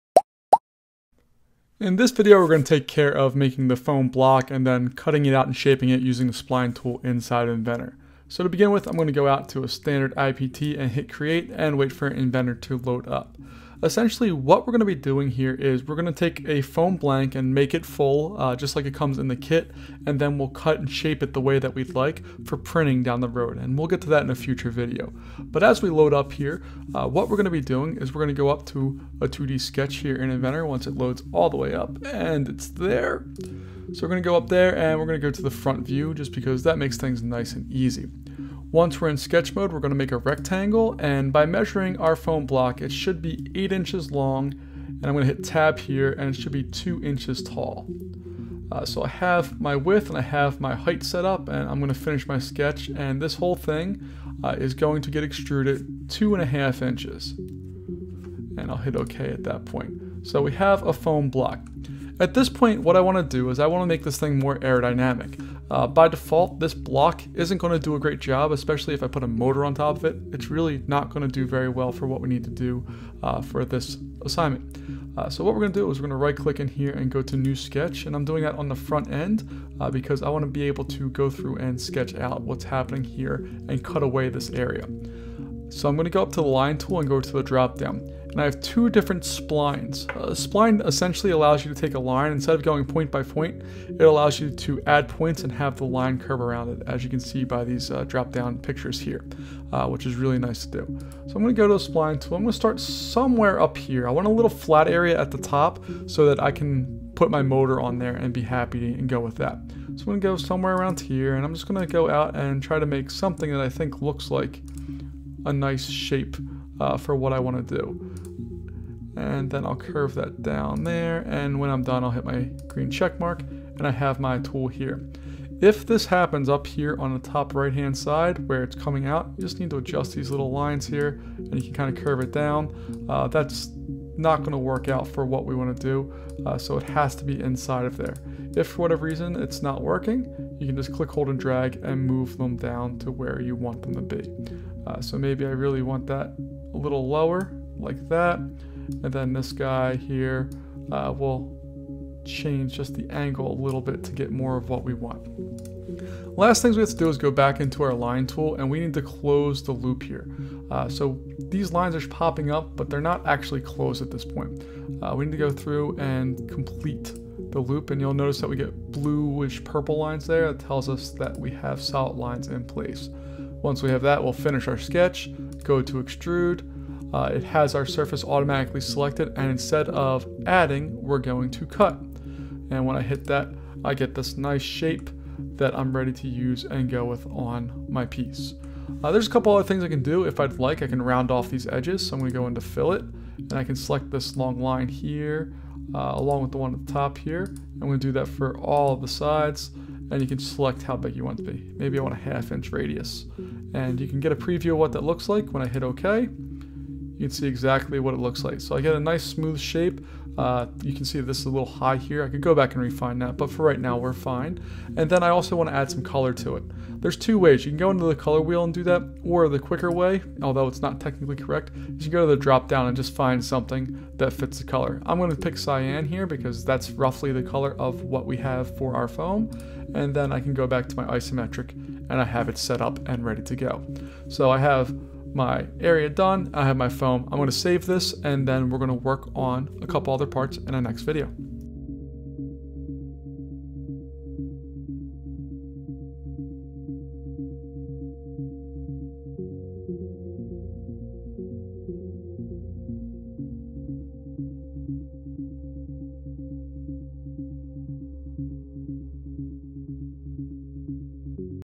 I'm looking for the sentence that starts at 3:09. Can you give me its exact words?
Uh, there's a couple other things I can do.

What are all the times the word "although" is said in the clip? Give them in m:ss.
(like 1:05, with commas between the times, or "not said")
3:40.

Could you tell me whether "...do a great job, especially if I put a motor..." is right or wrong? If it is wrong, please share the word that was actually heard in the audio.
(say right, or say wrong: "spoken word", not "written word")
right.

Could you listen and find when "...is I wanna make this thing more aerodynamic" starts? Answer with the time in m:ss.
1:03.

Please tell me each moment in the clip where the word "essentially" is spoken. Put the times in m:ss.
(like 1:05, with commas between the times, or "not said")
0:13, 1:30.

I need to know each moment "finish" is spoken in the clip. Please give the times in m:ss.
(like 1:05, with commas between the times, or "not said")
0:51, 2:54.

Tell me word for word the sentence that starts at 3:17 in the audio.
I'm gonna do that for all of the sides and you can select how big you want to be.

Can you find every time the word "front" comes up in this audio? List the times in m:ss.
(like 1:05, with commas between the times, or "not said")
0:35, 1:18.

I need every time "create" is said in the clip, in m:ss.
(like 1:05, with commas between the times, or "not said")
0:11.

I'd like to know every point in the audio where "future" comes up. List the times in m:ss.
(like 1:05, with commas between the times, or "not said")
0:24.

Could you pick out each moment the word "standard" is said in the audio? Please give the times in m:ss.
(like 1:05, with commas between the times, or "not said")
0:09.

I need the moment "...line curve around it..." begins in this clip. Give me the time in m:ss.
1:35.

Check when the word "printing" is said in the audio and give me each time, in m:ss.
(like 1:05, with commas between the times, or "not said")
0:22.